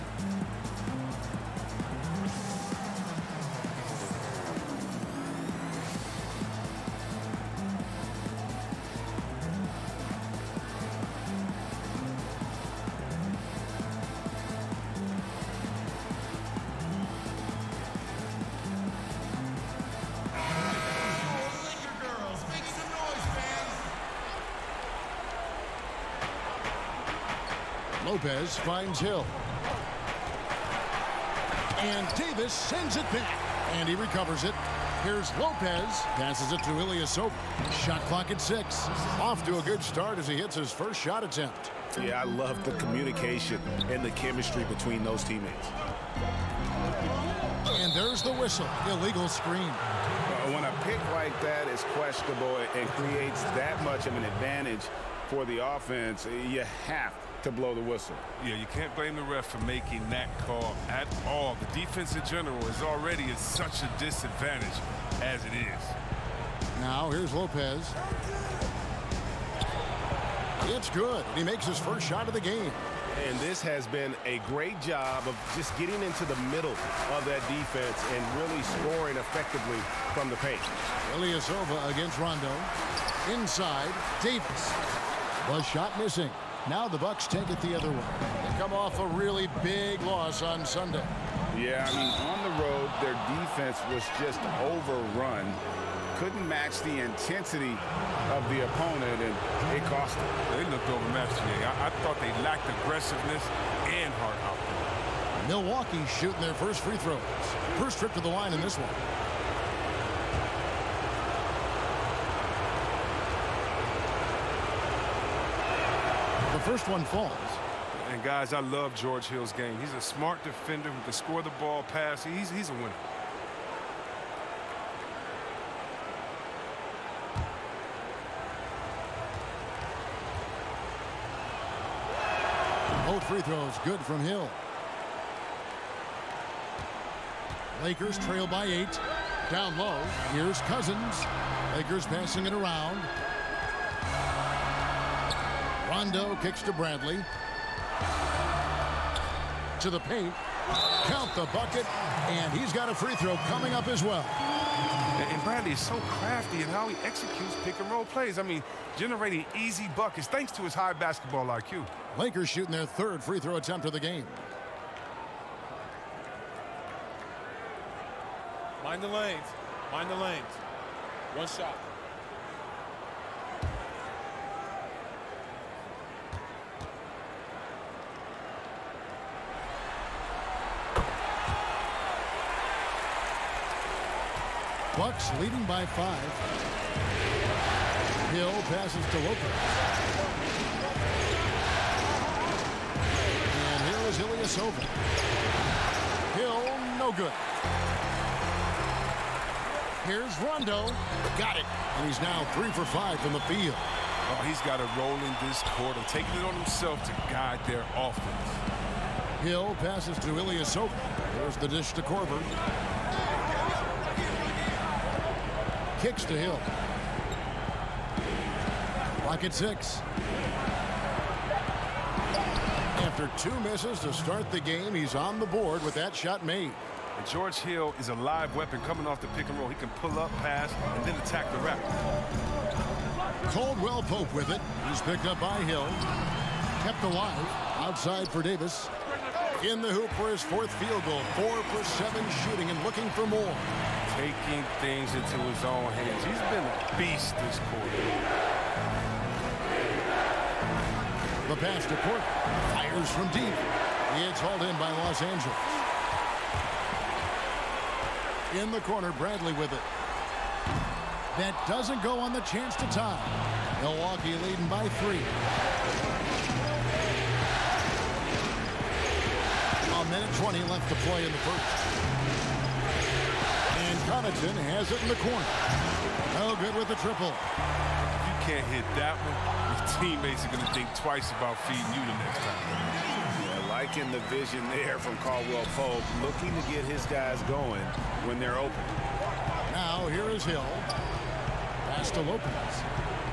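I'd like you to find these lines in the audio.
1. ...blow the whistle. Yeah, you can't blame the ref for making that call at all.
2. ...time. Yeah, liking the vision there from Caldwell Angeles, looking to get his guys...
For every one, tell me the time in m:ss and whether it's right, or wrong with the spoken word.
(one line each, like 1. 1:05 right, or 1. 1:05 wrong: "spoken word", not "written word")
1. 0:57 right
2. 4:42 wrong: "Pope", not "Angeles".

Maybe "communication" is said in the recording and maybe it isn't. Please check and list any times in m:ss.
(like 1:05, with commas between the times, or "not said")
0:42.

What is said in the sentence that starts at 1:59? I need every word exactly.
He's a smart defender who can score the ball, pass.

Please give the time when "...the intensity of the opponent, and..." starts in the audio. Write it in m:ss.
1:36.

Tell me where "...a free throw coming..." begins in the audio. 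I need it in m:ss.
2:32.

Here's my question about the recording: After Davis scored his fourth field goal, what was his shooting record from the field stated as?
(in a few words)
4 for 7.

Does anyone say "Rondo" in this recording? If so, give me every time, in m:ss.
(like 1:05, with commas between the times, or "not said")
1:22, 2:25, 3:20.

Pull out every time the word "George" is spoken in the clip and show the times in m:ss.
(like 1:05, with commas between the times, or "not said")
1:58, 3:47.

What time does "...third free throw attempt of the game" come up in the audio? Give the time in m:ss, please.
2:42.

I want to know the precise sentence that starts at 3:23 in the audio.
Oh, he's got a role in this quarter, taking it on himself to guide their offense.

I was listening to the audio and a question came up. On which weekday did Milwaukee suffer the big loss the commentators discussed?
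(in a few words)
Sunday.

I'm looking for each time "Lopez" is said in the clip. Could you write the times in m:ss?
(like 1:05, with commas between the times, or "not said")
0:28, 0:35, 1:07, 3:09, 4:52.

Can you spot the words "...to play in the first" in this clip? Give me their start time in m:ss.
4:30.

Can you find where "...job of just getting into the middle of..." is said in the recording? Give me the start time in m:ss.
1:14.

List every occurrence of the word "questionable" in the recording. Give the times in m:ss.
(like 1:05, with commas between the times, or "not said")
0:51.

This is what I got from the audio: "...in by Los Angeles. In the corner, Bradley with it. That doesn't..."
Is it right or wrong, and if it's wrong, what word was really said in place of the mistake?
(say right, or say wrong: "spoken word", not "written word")
right.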